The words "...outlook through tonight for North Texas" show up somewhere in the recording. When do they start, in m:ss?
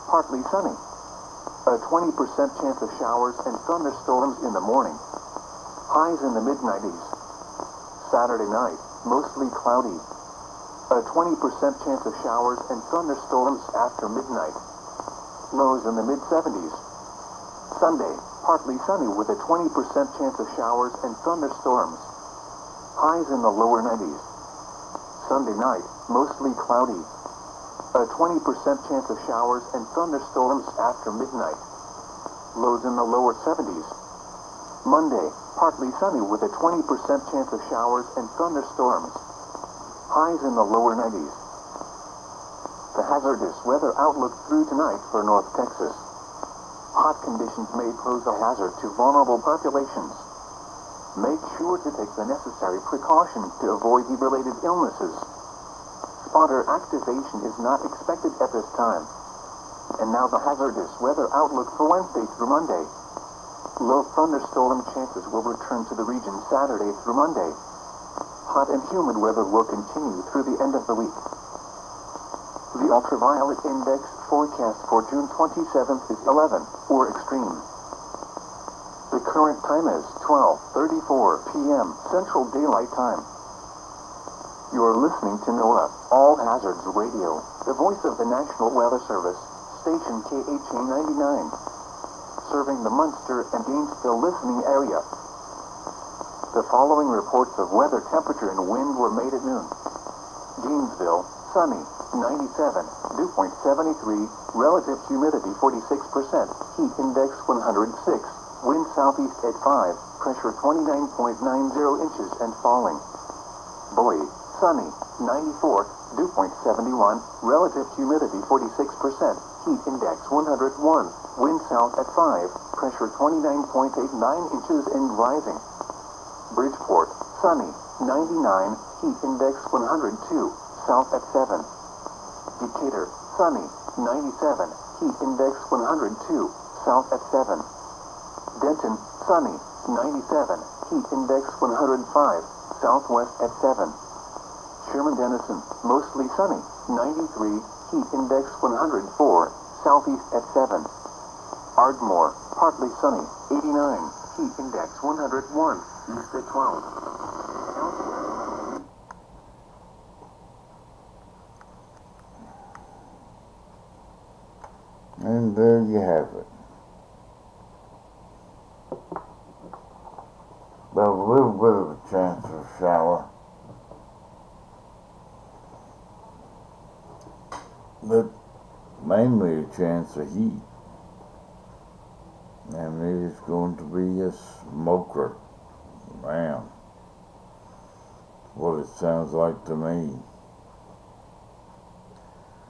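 0:43.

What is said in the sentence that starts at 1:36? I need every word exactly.
The following reports of weather temperature and wind were made at noon.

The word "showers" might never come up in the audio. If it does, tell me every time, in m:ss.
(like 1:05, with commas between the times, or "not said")
0:02, 0:12, 0:20, 0:29, 0:37, 2:52.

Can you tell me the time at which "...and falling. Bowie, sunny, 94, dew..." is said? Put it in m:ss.
1:52.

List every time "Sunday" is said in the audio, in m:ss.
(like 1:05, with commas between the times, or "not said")
0:17, 0:25.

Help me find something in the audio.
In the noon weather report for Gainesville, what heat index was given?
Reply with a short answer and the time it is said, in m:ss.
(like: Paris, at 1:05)
106, at 1:46.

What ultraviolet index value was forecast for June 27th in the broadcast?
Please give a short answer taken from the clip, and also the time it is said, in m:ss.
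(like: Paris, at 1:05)
11, at 1:16.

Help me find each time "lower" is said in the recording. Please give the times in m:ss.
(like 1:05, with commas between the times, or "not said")
0:23, 0:33, 0:40.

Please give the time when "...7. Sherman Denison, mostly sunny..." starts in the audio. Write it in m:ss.
2:23.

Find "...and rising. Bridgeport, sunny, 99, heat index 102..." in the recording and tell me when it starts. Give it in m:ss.
2:04.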